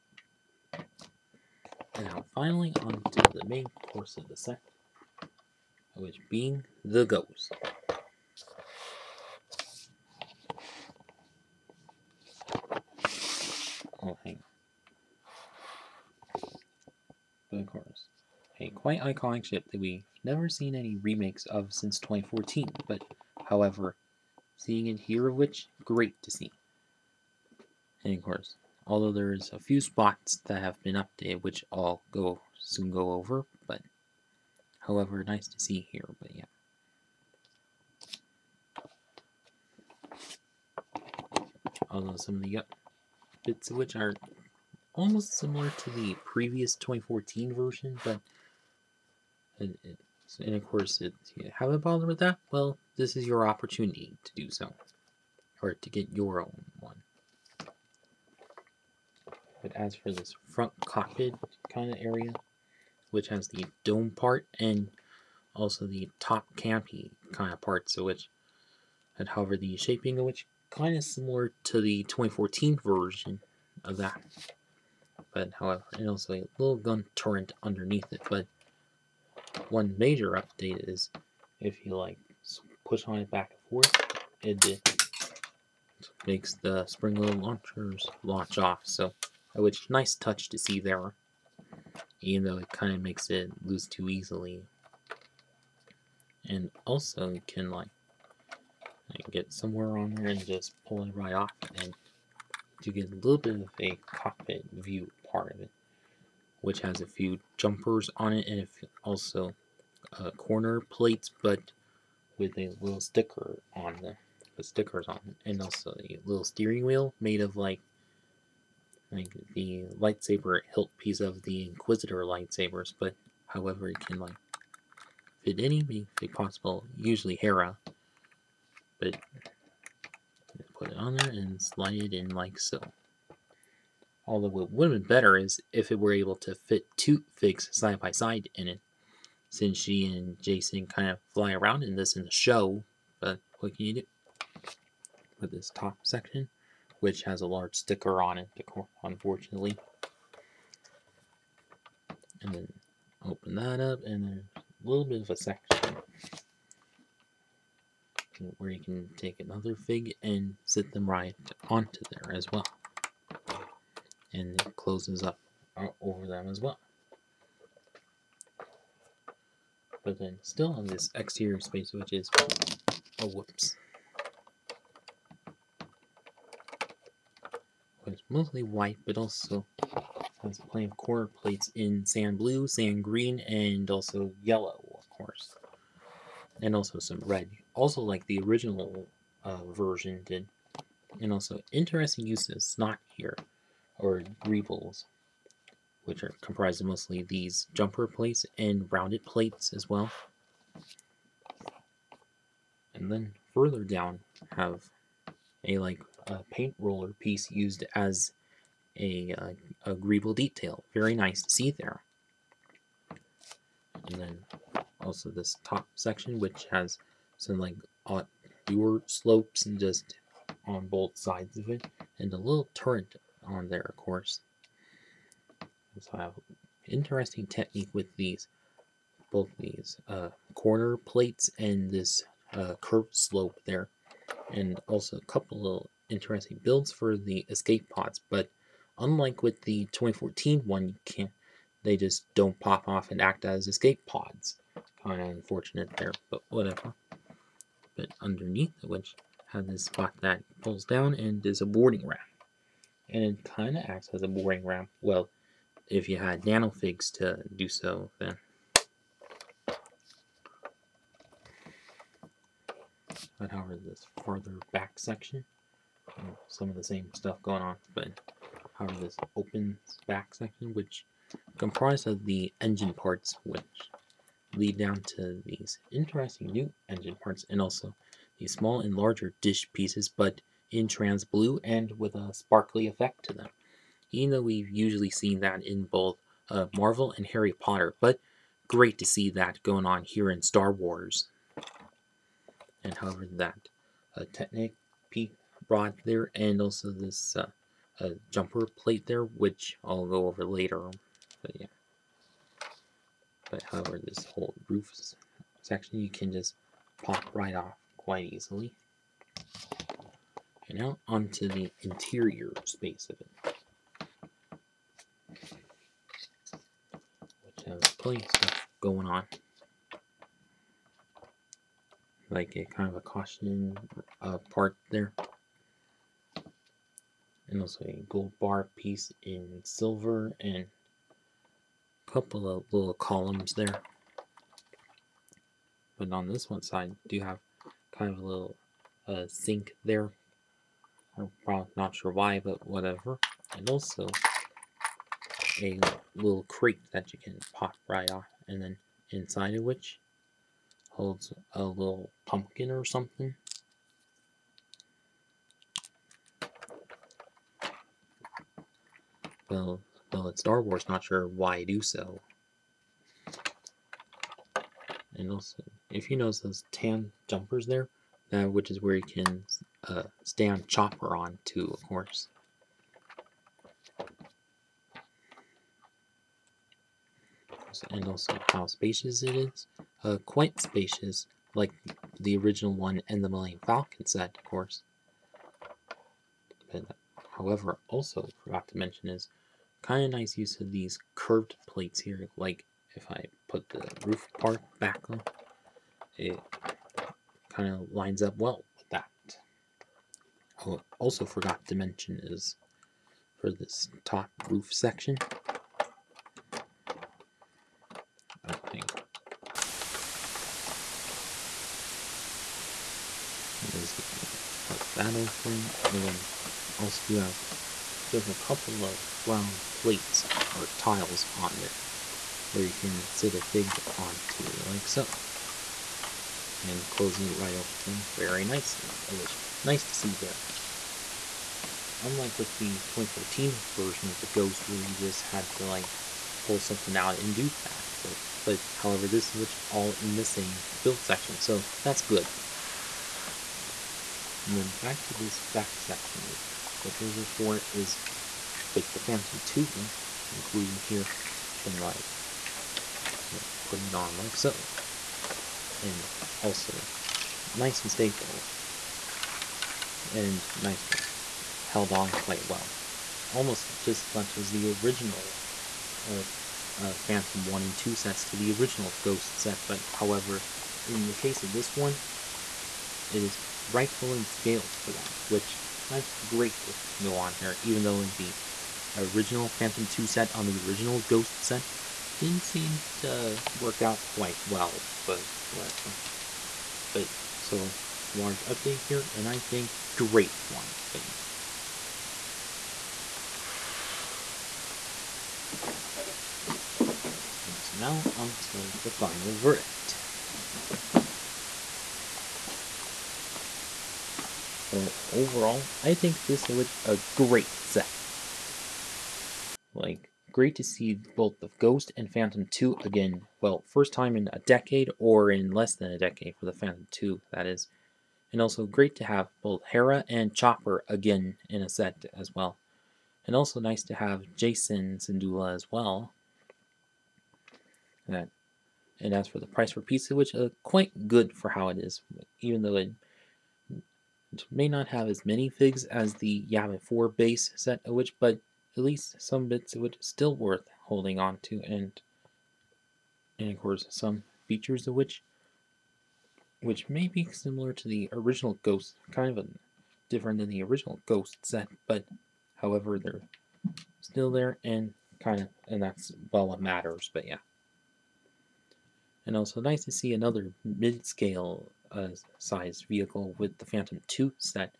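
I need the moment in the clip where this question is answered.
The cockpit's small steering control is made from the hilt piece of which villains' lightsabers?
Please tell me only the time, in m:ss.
2:01.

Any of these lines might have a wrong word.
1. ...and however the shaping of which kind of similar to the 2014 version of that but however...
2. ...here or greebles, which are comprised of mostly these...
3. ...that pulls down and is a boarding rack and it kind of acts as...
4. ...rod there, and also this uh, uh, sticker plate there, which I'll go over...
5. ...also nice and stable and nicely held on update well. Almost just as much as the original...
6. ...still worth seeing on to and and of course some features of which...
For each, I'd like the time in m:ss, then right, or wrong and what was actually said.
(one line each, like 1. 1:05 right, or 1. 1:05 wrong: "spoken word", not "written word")
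1. 1:09 right
2. 3:13 right
3. 4:10 right
4. 4:55 wrong: "jumper", not "sticker"
5. 7:36 wrong: "quite", not "update"
6. 8:59 wrong: "holding", not "seeing".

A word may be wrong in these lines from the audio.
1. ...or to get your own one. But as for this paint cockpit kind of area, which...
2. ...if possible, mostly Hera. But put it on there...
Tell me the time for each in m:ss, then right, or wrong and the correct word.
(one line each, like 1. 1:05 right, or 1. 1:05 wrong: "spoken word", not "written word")
1. 0:55 wrong: "front", not "paint"
2. 2:06 wrong: "usually", not "mostly".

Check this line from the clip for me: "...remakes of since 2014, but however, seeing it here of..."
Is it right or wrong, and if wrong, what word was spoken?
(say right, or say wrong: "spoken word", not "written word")
right.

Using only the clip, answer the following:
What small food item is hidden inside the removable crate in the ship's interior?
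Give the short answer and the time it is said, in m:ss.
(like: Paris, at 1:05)
pumpkin, at 5:52.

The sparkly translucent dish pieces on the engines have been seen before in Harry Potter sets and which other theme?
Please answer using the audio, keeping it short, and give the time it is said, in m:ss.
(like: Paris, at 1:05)
Marvel, at 4:46.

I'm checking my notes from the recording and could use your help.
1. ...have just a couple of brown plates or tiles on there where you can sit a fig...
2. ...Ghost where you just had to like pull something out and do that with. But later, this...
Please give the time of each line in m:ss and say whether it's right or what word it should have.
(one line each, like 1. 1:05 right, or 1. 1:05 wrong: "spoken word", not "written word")
1. 6:57 right
2. 7:14 wrong: "however", not "later".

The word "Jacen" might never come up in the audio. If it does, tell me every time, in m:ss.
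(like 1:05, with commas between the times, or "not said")
2:20, 8:44.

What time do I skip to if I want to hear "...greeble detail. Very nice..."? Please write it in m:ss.
3:29.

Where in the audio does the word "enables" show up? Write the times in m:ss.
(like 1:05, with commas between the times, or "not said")
not said.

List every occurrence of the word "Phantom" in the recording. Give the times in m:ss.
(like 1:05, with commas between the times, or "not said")
7:28, 7:47, 7:59, 8:32, 8:36, 9:23.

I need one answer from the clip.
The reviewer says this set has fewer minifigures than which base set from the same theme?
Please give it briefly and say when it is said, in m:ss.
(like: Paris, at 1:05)
Yavin 4 base, at 8:56.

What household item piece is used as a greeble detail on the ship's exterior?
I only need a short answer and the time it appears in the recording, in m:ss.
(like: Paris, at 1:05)
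paint roller, at 3:26.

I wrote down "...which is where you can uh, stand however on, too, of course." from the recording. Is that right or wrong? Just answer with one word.
wrong.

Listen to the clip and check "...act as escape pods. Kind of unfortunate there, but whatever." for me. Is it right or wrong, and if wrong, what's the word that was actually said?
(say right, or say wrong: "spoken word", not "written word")
right.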